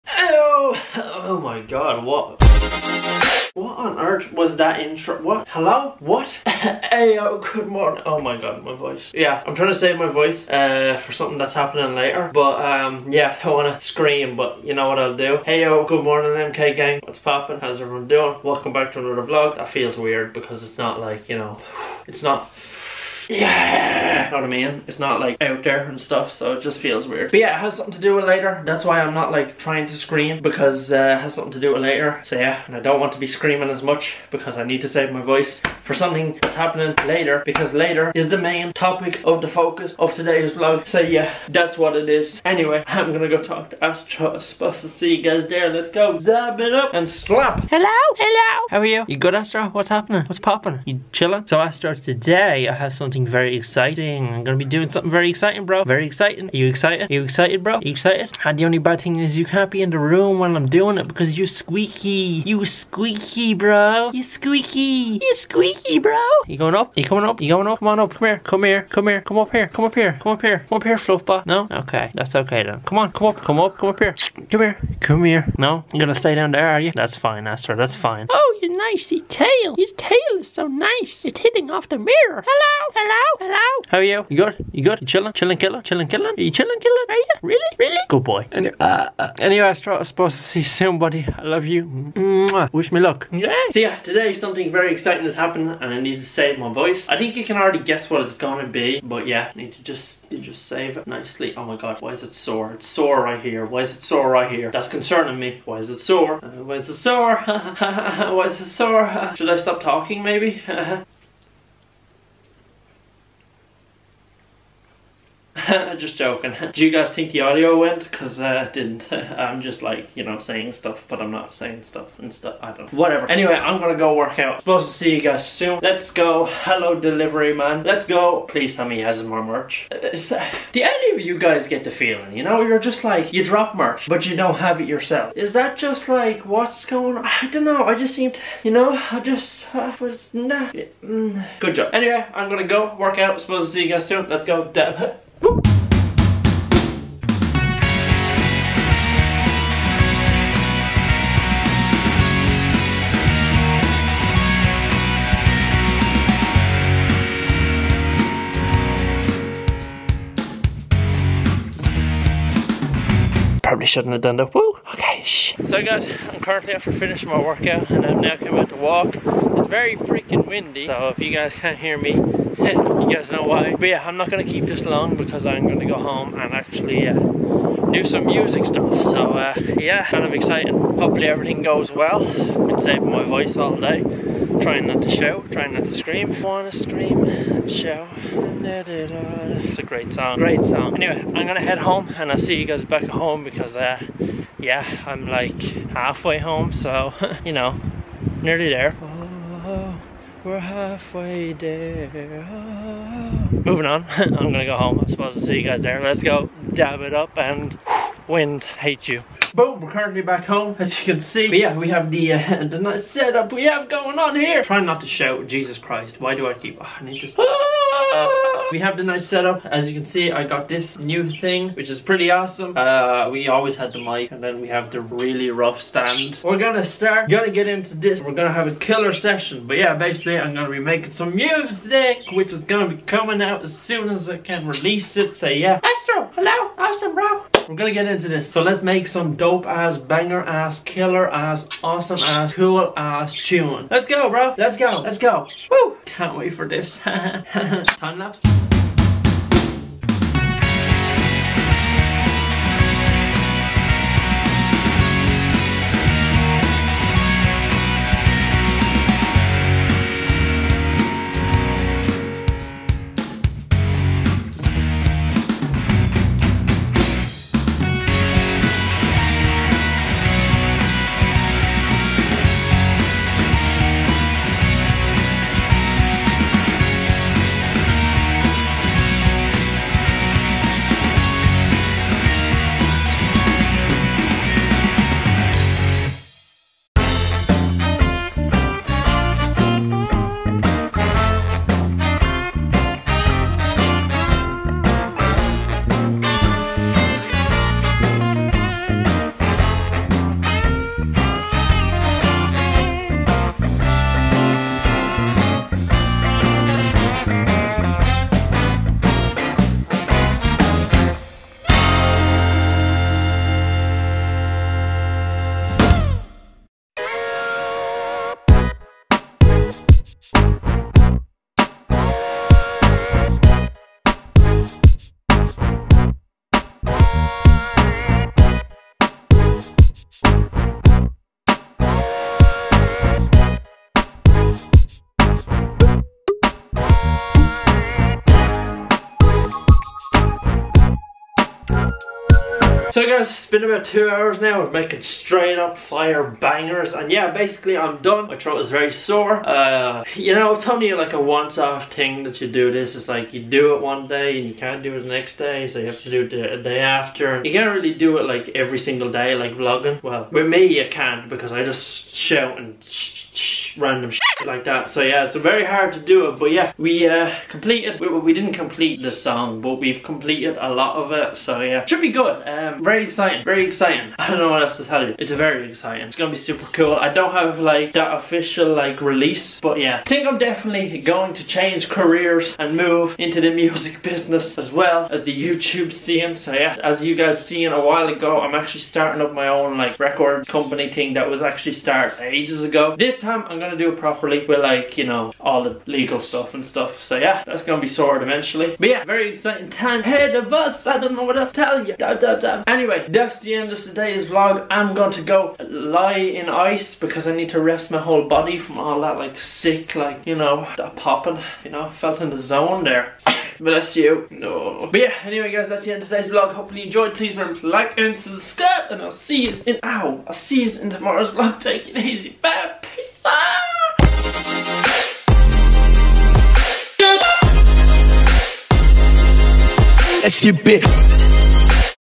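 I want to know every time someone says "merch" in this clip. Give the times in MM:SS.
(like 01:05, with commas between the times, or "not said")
02:09, 02:13.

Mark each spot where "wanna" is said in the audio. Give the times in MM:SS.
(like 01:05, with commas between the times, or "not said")
03:06.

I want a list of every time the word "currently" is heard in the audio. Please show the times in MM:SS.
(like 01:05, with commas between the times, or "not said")
02:46, 03:29.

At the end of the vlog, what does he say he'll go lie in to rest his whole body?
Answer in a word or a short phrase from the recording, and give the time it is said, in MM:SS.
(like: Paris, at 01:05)
Ice, at 06:46.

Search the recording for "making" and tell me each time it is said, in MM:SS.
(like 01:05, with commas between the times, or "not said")
03:50, 05:44.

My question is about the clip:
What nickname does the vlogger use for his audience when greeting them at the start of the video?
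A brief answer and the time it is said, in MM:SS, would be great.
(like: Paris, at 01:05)
MK gang, at 00:16.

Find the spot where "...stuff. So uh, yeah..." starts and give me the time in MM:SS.
02:58.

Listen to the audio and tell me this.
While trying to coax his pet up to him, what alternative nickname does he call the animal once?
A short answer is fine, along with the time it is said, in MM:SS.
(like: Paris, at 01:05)
Fluffbot, at 01:10.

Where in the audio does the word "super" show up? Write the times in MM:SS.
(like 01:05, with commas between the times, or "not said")
06:16.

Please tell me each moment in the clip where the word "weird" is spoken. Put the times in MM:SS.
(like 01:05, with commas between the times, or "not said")
00:19, 00:27.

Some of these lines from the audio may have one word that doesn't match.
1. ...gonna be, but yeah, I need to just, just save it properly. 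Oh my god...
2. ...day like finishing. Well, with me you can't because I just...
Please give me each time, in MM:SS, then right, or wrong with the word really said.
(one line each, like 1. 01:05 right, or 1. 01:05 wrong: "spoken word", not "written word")
1. 01:38 wrong: "nicely", not "properly"
2. 05:59 wrong: "vlogging", not "finishing".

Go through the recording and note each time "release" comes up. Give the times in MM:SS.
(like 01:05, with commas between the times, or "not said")
03:54, 06:19.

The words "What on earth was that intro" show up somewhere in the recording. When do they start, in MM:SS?
00:03.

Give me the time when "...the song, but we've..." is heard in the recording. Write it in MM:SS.
06:09.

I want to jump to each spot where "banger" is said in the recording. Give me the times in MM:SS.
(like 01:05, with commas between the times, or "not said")
03:59, 05:46.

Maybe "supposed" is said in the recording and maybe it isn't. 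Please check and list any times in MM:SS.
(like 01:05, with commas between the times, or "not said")
00:44, 01:30, 02:04, 02:23, 03:25.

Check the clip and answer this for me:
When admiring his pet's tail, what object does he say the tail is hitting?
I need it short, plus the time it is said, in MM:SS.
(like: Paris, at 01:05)
The mirror, at 01:21.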